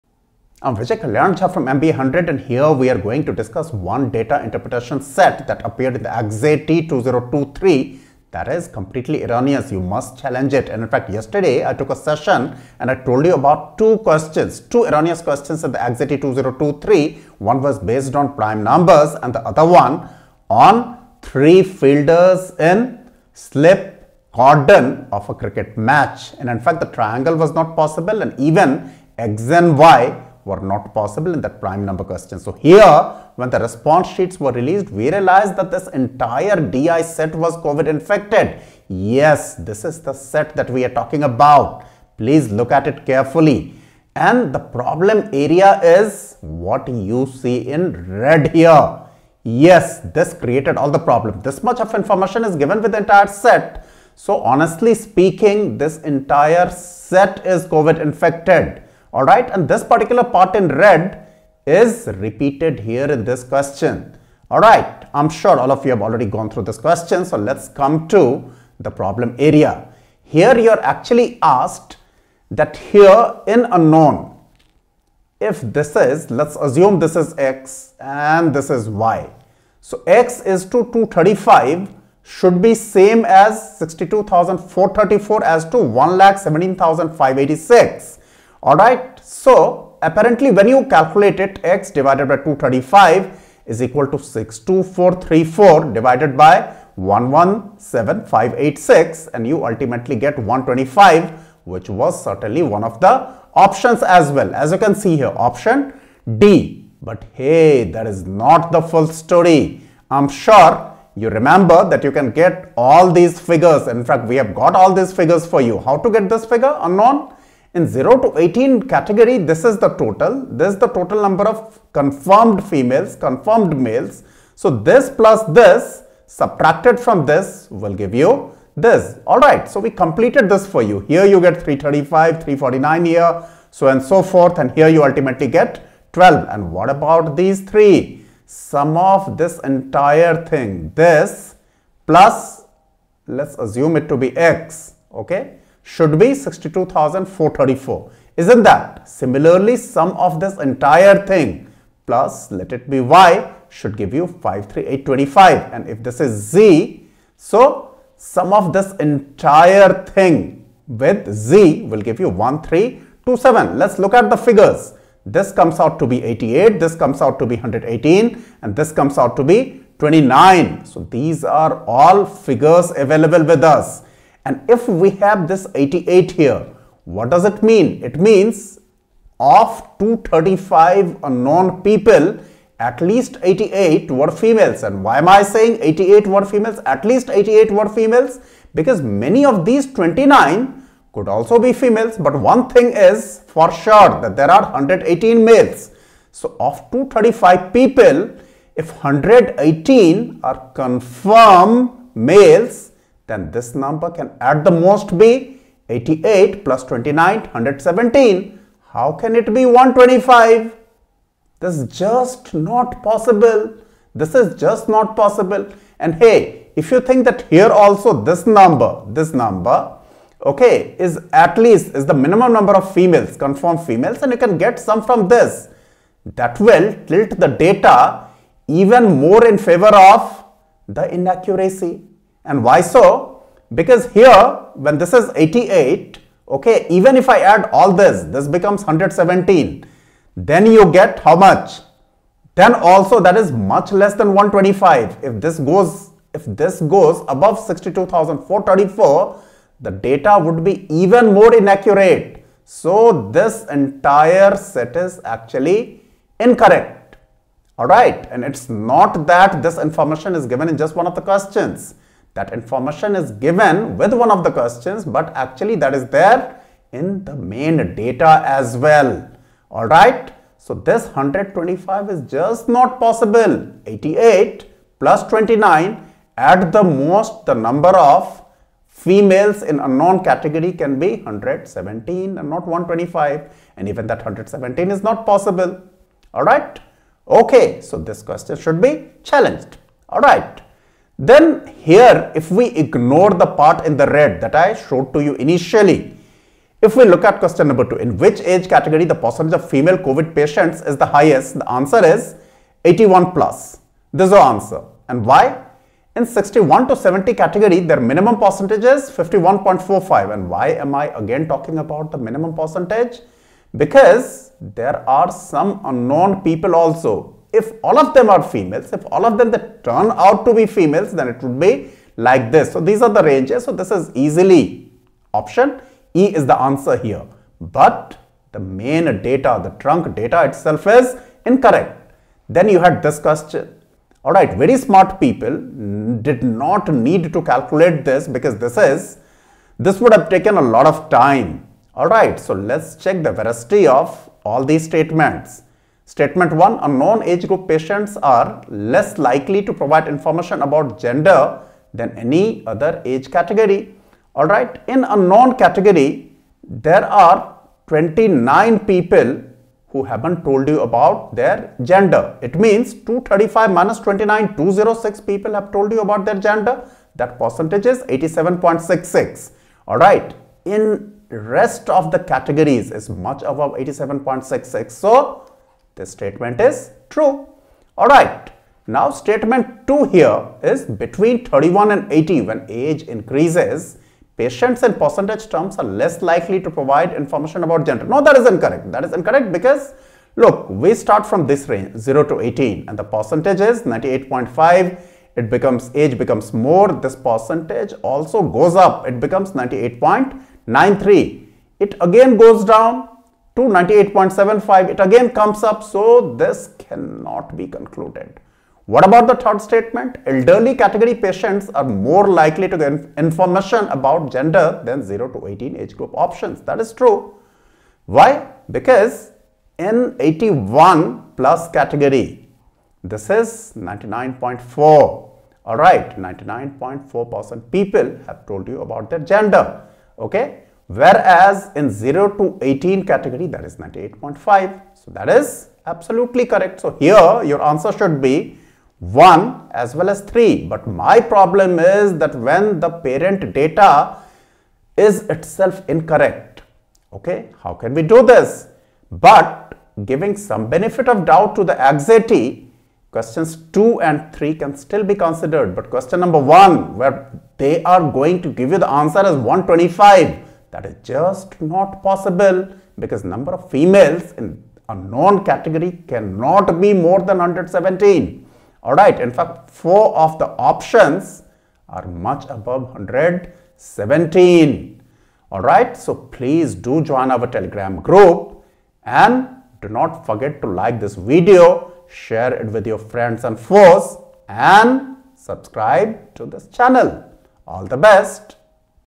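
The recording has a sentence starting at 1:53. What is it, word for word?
In fact, we have got all these figures for you.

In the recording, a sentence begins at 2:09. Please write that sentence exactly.
Alright, so we completed this for you.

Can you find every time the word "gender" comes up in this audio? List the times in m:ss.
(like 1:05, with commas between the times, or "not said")
5:50, 6:01, 6:06, 6:27, 6:54, 7:09.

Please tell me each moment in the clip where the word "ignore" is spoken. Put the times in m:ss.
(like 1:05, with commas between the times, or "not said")
4:52.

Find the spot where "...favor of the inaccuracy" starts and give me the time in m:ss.
3:49.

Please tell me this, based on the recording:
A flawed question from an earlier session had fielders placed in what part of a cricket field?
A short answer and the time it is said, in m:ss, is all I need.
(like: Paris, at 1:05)
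slip cordon, at 0:23.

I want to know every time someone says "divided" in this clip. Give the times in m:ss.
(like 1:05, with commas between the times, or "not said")
1:31, 1:35.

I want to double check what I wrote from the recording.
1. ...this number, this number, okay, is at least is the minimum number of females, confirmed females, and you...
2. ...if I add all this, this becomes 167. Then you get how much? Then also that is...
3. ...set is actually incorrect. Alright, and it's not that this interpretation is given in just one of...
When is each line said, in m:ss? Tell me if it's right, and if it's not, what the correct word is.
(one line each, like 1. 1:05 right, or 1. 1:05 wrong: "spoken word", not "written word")
1. 3:38 right
2. 3:57 wrong: "117", not "167"
3. 4:14 wrong: "information", not "interpretation".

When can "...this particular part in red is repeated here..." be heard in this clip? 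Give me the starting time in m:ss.
0:59.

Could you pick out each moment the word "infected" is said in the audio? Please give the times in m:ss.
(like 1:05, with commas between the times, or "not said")
0:37, 0:58.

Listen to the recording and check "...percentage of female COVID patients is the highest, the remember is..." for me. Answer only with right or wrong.
wrong.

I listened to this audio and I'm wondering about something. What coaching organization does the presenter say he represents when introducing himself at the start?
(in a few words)
MBA 100.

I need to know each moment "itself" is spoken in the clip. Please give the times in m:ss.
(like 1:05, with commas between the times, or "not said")
5:30, 7:25.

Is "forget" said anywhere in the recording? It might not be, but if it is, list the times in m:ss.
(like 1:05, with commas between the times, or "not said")
8:00.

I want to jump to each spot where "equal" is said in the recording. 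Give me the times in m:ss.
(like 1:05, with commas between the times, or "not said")
1:33.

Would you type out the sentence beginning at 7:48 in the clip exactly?
Alright, in fact, four of the options are much above 117.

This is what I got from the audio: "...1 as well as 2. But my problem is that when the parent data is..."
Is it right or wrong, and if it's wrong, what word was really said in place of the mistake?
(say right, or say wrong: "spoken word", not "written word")
wrong: "3", not "2".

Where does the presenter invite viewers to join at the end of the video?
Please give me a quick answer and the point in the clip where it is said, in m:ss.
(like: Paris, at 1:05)
telegram group, at 7:57.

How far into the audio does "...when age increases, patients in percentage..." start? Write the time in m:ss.
6:22.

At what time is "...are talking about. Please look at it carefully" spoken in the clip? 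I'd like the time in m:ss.
0:40.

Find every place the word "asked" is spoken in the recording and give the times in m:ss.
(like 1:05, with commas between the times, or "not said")
1:11.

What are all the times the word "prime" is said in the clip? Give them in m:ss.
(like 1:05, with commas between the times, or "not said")
0:18, 0:31.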